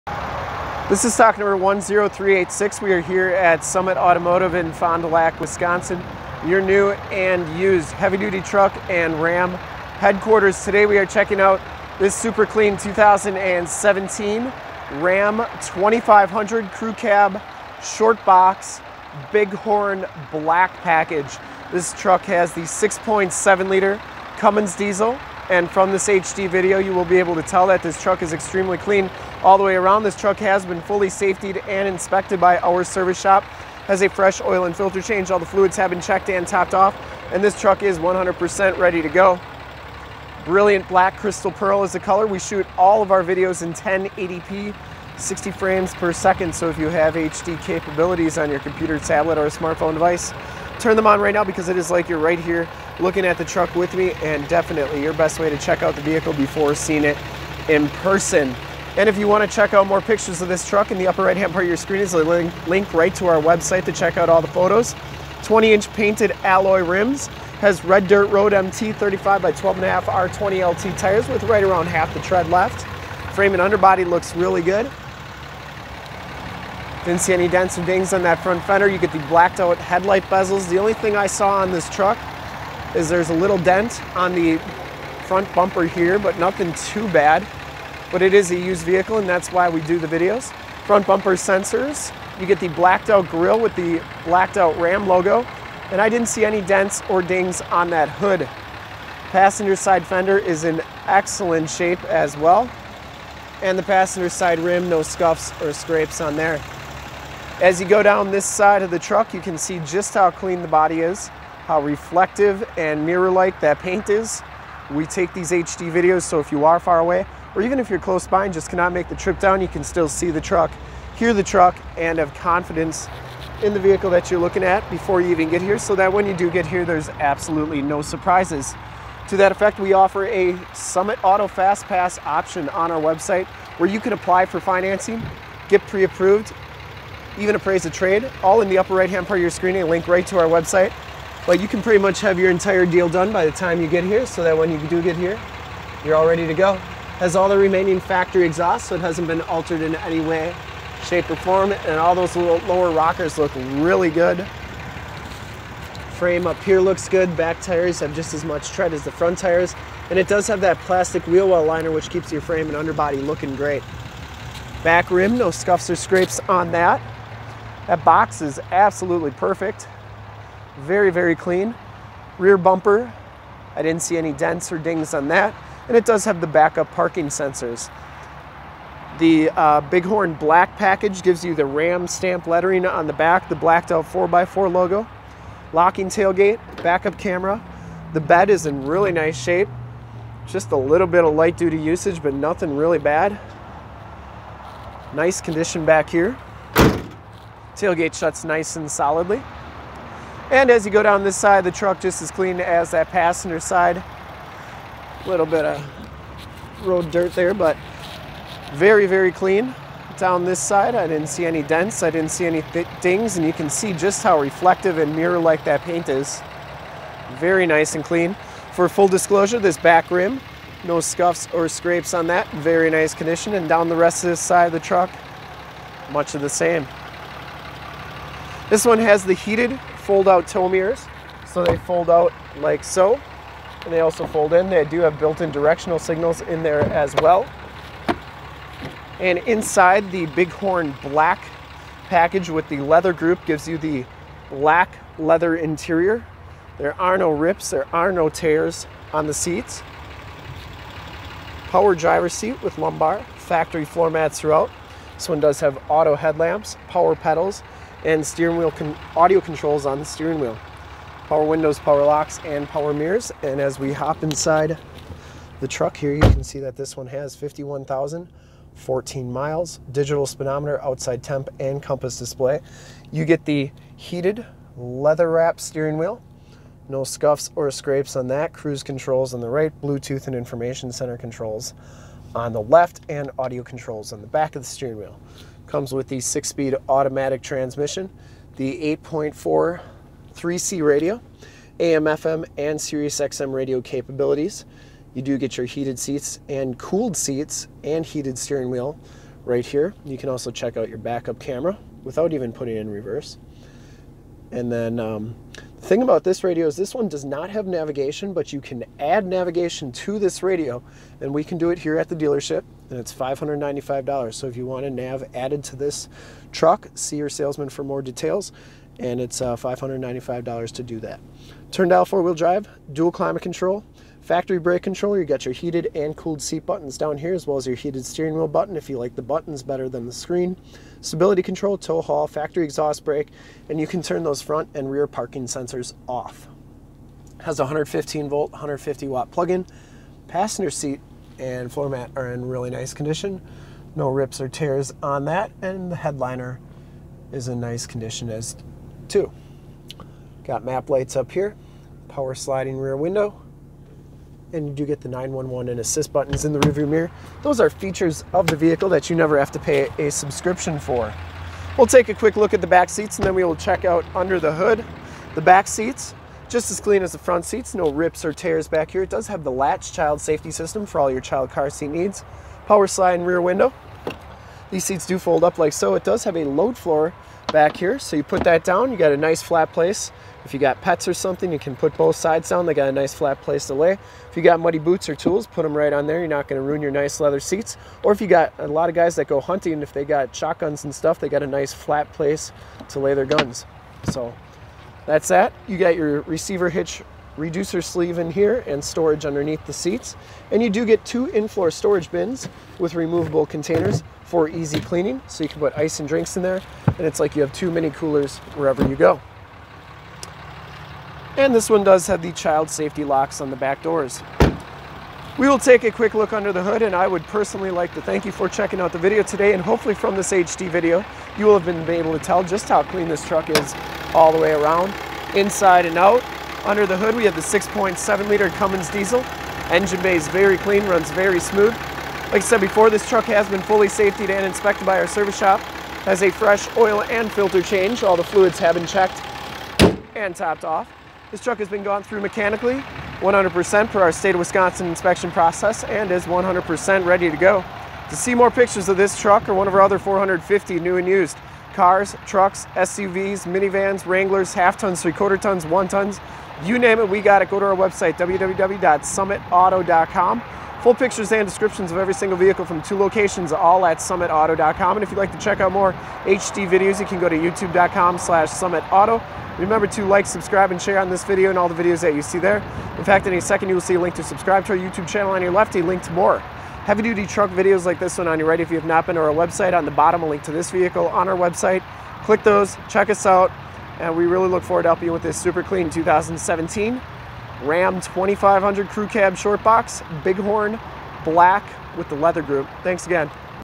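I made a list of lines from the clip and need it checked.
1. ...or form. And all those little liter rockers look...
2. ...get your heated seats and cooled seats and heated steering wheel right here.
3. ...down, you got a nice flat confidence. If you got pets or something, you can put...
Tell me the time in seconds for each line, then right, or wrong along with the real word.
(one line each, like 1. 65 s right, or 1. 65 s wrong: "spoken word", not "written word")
1. 151 s wrong: "lower", not "liter"
2. 295 s right
3. 378 s wrong: "place", not "confidence".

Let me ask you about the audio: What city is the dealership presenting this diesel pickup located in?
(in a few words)
Fond du Lac.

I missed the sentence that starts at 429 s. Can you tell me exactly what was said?
Engine bay is very clean, runs very smooth.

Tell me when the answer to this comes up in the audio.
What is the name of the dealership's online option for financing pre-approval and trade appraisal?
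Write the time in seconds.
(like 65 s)
130 s.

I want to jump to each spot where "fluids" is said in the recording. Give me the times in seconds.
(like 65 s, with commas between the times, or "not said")
35 s, 438 s.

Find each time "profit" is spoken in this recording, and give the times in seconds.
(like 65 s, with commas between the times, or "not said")
not said.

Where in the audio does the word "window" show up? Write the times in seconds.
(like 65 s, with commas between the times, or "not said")
261 s, 352 s, 373 s.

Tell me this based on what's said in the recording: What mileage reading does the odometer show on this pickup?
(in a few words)
51,014 miles.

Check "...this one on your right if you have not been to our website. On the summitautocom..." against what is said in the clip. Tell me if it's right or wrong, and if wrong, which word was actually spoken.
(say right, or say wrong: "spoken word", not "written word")
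wrong: "bottom", not "summitautocom".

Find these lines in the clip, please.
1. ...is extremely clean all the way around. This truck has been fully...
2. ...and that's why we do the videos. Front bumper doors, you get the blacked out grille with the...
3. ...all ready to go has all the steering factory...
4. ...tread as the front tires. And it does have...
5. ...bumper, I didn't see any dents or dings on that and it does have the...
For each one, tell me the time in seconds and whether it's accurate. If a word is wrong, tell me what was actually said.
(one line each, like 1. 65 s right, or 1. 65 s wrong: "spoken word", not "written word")
1. 28 s right
2. 89 s wrong: "sensors", not "doors"
3. 146 s wrong: "remaining", not "steering"
4. 158 s right
5. 172 s right.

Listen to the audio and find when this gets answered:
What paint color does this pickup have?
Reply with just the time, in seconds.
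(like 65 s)
40 s.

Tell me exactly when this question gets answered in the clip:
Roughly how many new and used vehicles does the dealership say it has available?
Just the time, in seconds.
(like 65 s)
449 s.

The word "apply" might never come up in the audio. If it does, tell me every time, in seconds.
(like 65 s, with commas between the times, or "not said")
134 s.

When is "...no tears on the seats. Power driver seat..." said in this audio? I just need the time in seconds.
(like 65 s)
248 s.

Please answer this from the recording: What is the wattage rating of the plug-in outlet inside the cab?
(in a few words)
150 watt.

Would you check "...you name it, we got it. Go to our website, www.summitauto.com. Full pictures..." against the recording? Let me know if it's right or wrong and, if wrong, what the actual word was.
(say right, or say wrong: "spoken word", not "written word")
right.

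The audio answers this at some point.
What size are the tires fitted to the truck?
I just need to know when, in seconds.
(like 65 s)
68 s.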